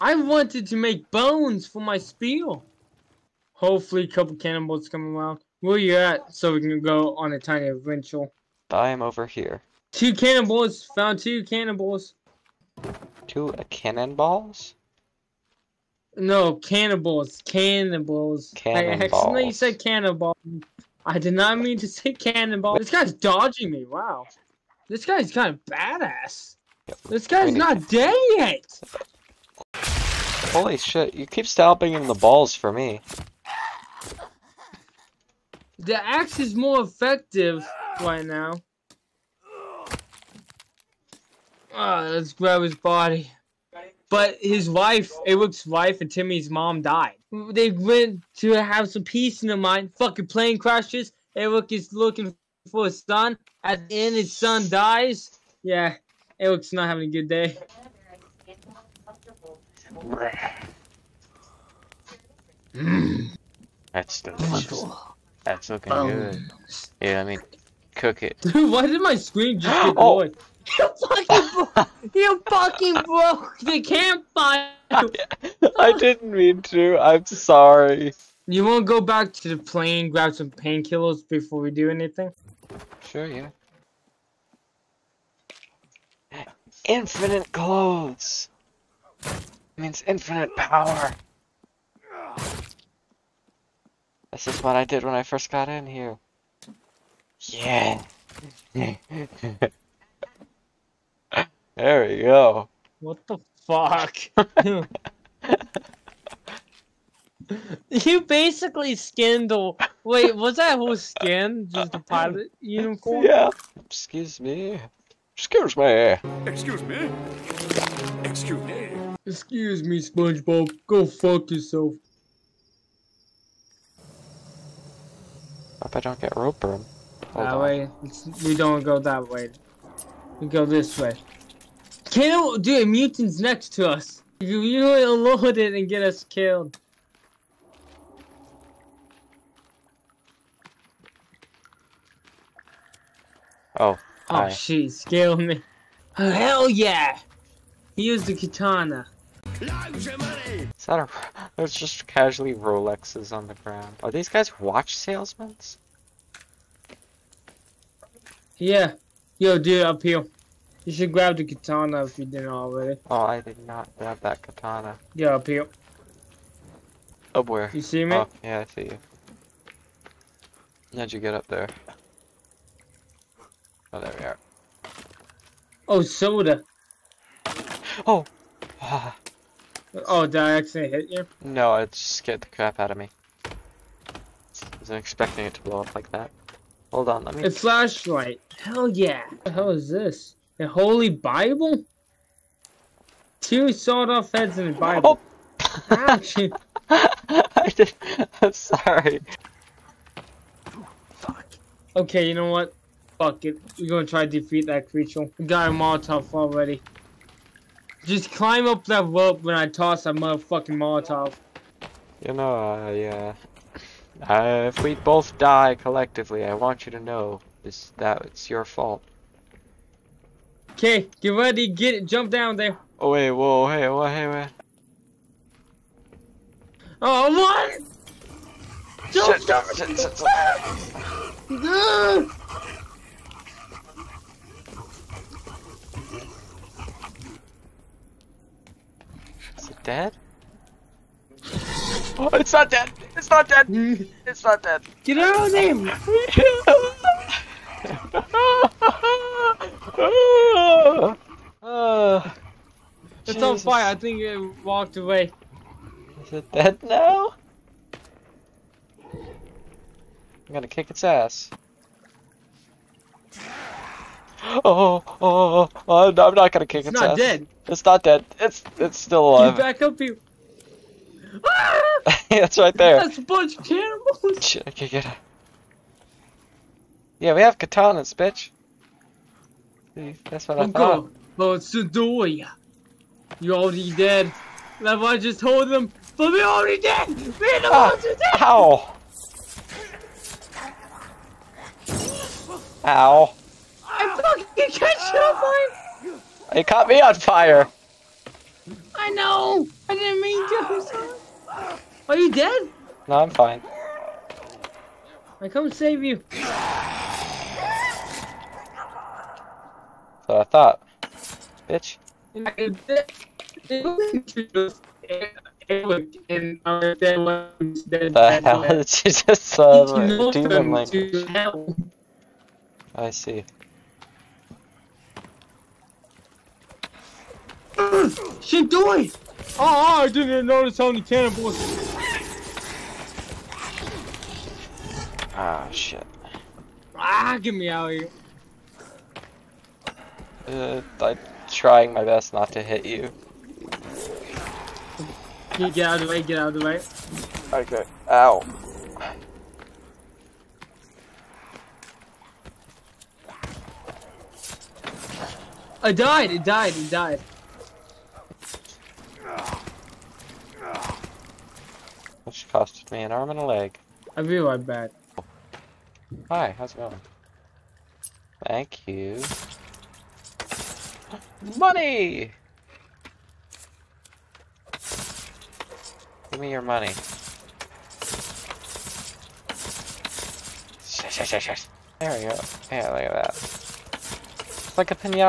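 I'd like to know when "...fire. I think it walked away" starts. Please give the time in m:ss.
4:13.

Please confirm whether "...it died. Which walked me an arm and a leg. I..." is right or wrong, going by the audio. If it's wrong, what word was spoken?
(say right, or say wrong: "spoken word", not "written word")
wrong: "costed", not "walked".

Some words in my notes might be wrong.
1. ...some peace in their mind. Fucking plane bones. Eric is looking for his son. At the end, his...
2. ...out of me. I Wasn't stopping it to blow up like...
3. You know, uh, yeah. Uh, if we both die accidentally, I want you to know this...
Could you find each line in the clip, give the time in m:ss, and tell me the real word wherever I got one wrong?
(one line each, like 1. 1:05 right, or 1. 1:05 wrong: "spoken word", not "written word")
1. 0:48 wrong: "crashes", not "bones"
2. 3:02 wrong: "expecting", not "stopping"
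3. 3:32 wrong: "collectively", not "accidentally".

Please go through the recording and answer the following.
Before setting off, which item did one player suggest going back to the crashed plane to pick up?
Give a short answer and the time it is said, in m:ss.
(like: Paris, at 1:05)
Painkillers, at 1:20.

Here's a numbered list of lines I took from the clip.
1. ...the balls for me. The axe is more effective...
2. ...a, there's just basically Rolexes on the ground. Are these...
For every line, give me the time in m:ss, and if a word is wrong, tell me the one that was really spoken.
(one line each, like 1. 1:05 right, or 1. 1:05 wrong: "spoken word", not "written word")
1. 0:32 right
2. 2:31 wrong: "casually", not "basically".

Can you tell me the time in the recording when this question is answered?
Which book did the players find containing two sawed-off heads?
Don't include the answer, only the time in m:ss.
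3:10.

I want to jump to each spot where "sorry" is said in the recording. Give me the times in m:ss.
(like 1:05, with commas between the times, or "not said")
1:17, 3:18.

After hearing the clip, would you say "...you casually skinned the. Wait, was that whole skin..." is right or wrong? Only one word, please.
wrong.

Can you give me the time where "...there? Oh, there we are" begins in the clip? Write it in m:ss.
2:51.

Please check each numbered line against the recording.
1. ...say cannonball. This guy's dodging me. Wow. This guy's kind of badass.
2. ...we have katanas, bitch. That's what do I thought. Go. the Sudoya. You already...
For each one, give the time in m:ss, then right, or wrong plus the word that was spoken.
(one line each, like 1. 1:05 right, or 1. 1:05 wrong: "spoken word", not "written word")
1. 0:21 right
2. 4:37 right.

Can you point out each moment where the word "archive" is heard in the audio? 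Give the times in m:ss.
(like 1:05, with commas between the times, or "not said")
not said.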